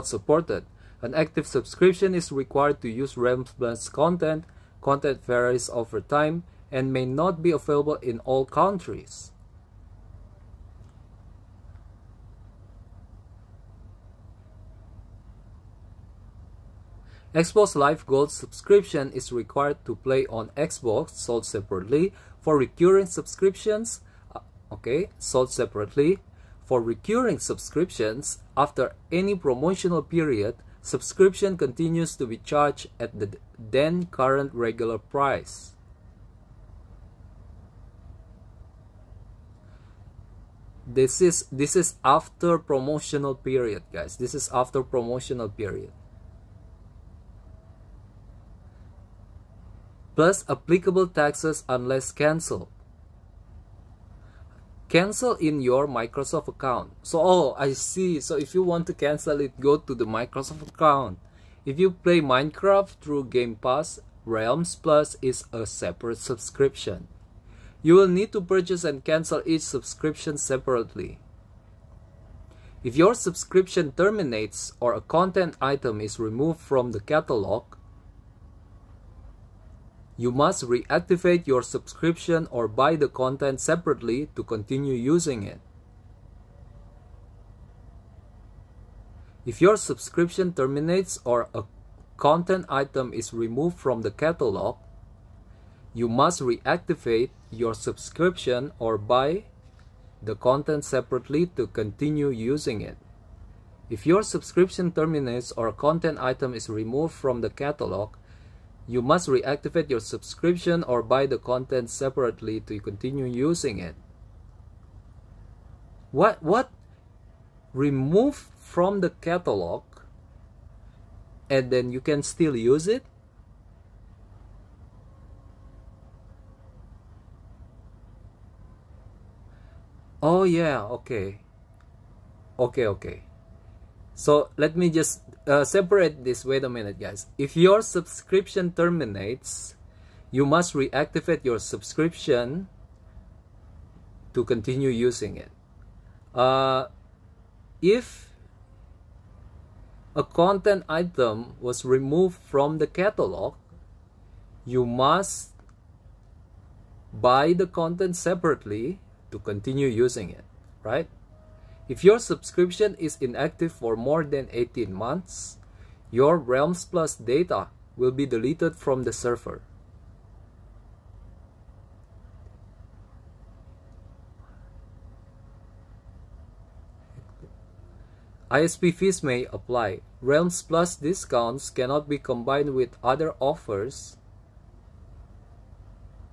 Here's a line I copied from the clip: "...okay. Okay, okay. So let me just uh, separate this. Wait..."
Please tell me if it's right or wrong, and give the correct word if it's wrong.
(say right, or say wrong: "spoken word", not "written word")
right.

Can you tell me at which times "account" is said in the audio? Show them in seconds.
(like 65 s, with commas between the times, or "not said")
56 s, 60 s.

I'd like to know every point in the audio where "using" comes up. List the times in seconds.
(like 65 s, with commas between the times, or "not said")
84 s, 102 s, 113 s, 144 s, 159 s.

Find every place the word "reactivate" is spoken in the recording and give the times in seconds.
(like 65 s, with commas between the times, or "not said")
80 s, 96 s, 109 s, 140 s.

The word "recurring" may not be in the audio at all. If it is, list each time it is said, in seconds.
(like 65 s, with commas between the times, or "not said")
22 s, 26 s.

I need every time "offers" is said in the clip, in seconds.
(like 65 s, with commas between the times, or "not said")
183 s.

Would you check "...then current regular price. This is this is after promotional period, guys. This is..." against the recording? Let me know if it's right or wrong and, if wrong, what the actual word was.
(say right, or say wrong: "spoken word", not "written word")
right.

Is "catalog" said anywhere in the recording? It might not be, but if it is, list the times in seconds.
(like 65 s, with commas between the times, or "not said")
77 s, 94 s, 107 s, 119 s, 152 s.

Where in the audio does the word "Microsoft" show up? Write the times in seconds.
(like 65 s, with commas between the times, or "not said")
55 s, 60 s.